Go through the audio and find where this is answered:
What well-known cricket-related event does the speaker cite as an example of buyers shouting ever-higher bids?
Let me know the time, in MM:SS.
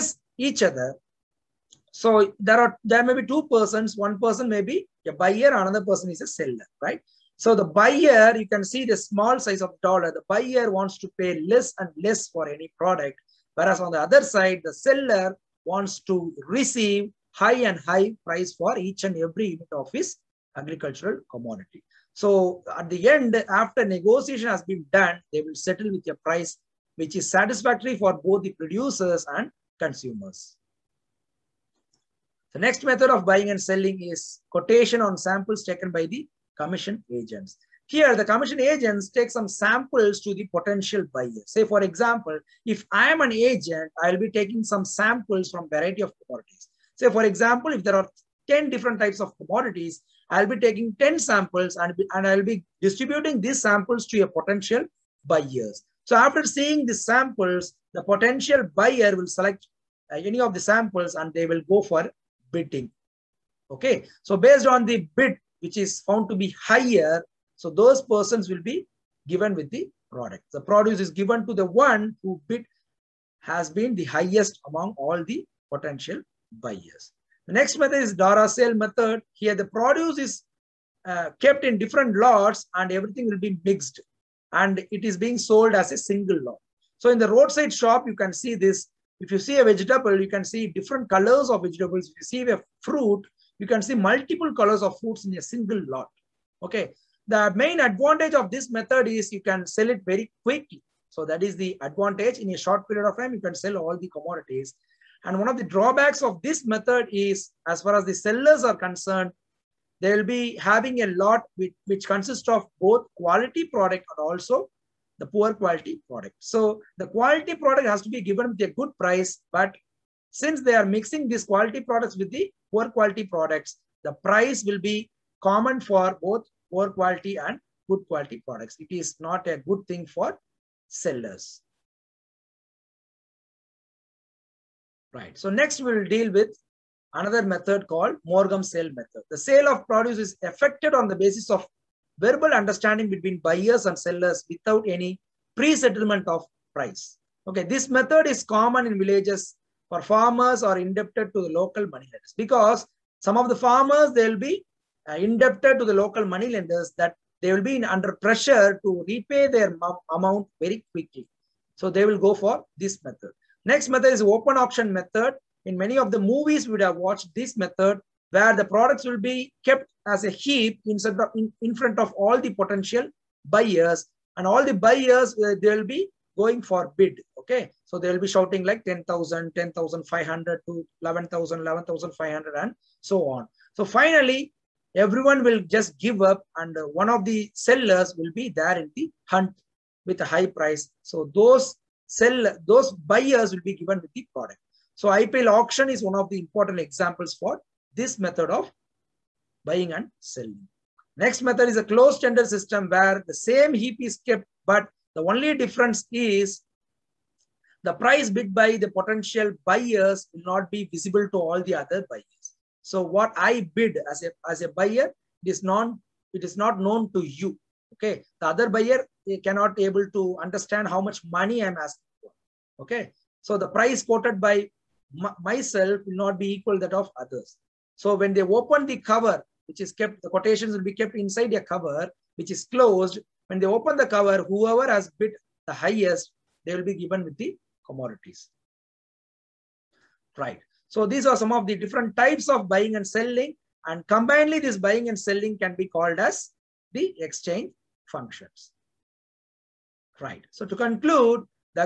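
03:15.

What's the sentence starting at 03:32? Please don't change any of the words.
So what I bid as a, as a buyer it is non it is not known to you.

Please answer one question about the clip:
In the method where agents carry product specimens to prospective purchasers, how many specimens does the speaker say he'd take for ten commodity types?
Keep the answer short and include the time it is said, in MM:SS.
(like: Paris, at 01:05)
10 samples, at 00:51.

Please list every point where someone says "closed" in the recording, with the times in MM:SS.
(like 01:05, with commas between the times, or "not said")
03:21, 03:52.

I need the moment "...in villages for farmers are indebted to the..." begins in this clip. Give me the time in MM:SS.
02:28.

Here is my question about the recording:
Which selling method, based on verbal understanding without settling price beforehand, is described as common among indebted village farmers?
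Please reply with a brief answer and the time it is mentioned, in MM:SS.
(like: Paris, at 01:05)
Moghum sale method, at 02:18.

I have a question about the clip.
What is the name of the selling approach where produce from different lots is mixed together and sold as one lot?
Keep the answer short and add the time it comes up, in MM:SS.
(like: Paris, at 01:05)
Dara sale method, at 01:18.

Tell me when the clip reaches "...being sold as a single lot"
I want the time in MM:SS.
01:25.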